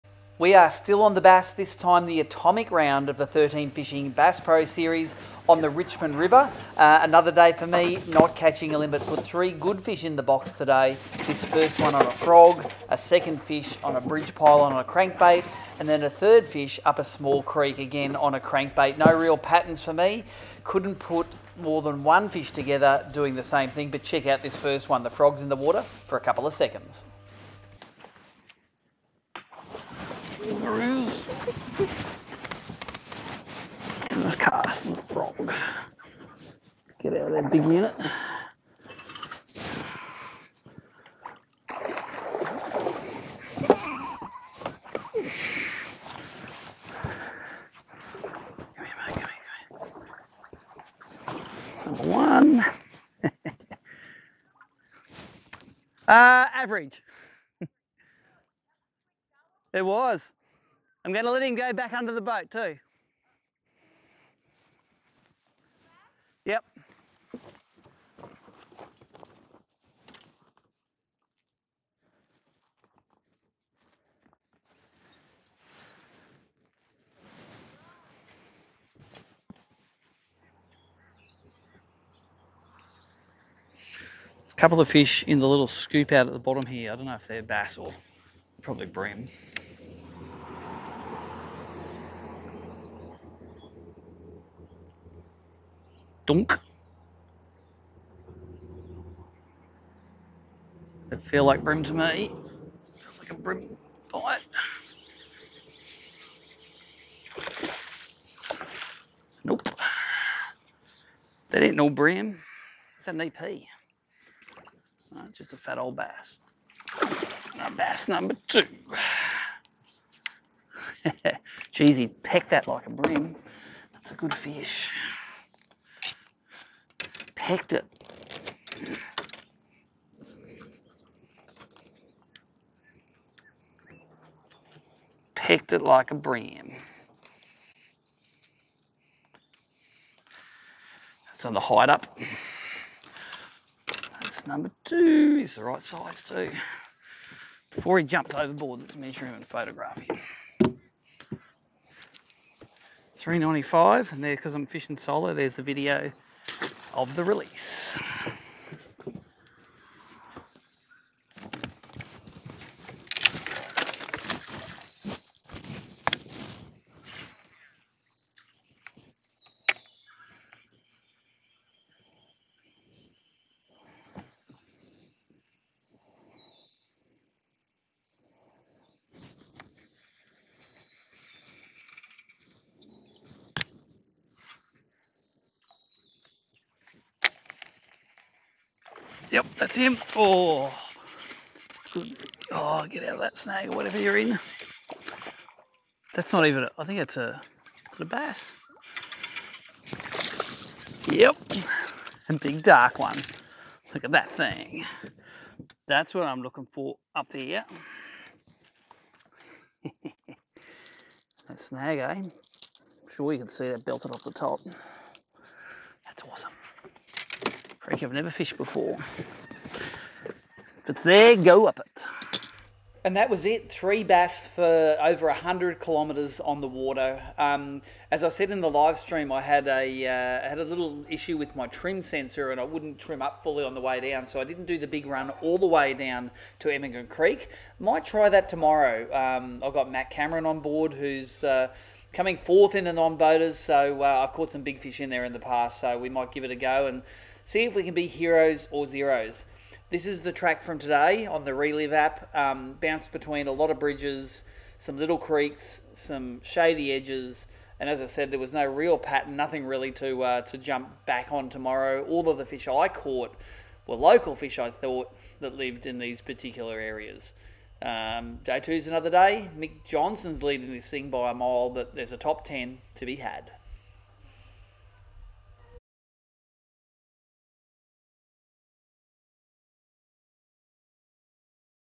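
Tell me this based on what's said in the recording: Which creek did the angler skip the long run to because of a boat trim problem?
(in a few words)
Emigrant Creek.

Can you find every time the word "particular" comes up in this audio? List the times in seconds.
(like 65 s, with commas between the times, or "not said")
266 s.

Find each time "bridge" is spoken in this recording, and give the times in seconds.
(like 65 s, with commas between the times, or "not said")
14 s, 253 s.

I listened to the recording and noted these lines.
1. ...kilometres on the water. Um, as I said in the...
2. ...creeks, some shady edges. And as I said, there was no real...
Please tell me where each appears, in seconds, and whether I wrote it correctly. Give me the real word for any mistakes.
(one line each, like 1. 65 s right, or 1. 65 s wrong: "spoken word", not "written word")
1. 225 s right
2. 255 s right.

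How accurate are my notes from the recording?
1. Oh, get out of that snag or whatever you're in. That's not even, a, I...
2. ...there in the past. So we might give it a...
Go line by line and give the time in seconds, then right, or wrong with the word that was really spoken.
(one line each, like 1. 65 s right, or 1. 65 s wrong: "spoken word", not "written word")
1. 192 s right
2. 245 s right.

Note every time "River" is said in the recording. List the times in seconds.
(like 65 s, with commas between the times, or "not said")
6 s.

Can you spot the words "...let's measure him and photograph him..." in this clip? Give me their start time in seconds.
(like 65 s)
148 s.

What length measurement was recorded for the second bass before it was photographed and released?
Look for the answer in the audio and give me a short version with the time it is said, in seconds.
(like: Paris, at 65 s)
395, at 153 s.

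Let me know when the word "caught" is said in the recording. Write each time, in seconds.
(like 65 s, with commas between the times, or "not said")
244 s, 262 s.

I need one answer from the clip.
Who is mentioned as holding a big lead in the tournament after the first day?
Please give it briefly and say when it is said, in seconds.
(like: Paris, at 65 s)
Mick Johnson, at 269 s.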